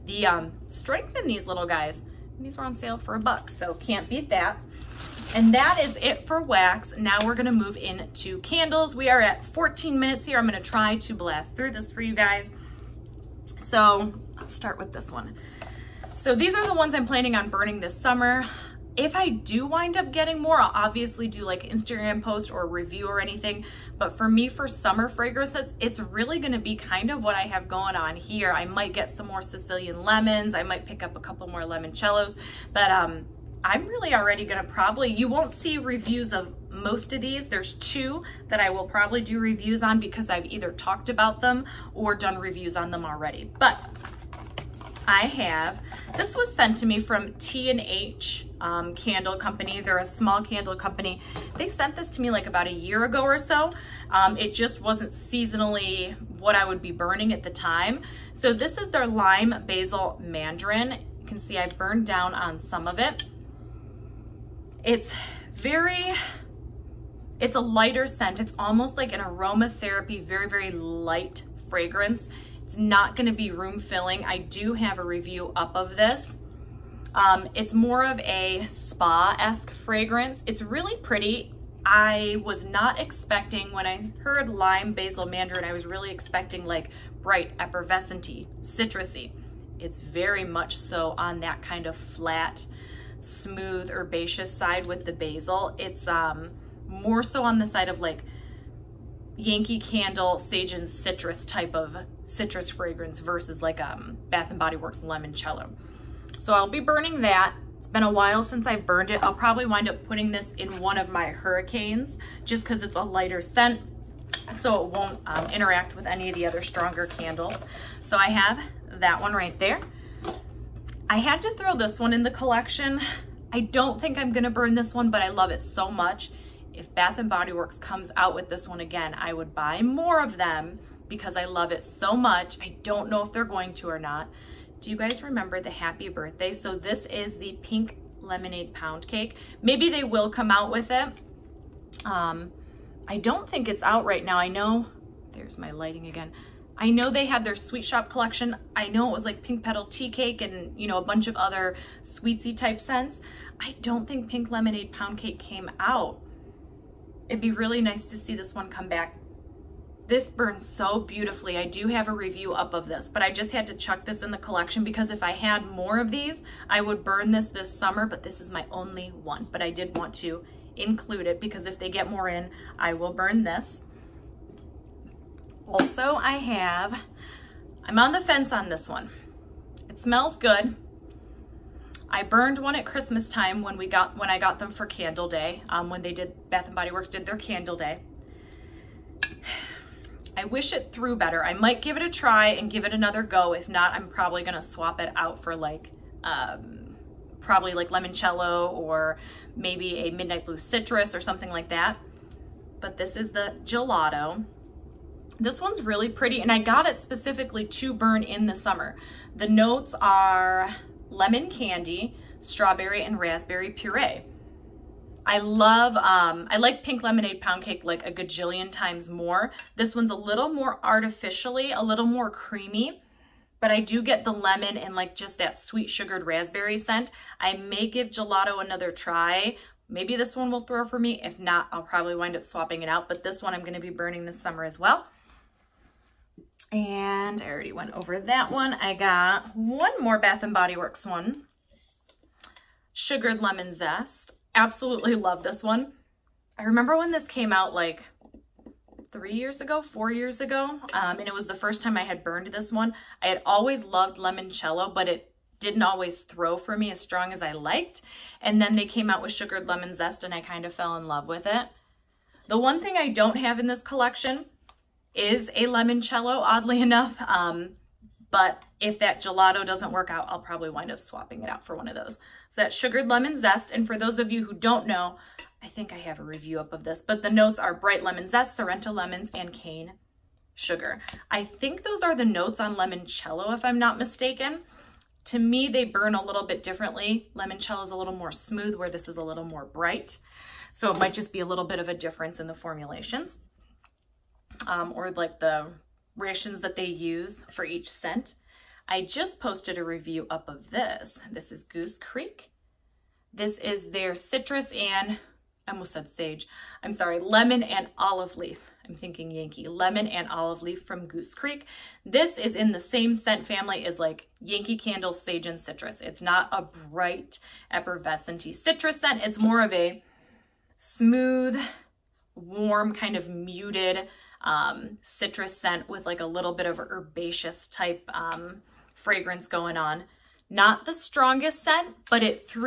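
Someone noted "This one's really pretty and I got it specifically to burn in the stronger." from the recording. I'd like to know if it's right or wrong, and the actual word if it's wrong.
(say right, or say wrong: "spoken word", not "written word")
wrong: "summer", not "stronger".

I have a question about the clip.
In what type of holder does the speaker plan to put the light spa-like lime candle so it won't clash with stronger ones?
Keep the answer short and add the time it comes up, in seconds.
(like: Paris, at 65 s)
Hurricanes, at 111 s.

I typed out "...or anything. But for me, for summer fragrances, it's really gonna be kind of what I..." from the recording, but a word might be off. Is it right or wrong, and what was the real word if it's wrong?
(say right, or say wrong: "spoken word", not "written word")
right.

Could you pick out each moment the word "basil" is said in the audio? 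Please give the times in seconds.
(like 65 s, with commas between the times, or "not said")
59 s, 84 s, 95 s.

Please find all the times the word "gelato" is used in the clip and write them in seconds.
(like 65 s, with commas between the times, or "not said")
203 s, 228 s, 269 s.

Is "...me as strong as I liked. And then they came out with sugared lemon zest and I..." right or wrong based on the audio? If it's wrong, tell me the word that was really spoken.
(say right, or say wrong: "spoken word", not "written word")
right.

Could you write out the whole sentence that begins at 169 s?
But I did want to include it because if they get more in, I will burn this.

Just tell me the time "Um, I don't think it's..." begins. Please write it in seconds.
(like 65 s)
142 s.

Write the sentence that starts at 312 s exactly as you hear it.
This is in the same scent family as like Yankee Candle, sage, and citrus.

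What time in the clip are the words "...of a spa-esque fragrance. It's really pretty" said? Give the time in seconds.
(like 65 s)
78 s.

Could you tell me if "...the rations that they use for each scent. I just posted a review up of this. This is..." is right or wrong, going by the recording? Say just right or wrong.
right.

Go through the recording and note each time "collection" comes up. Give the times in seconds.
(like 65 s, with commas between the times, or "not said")
122 s, 148 s, 164 s, 263 s.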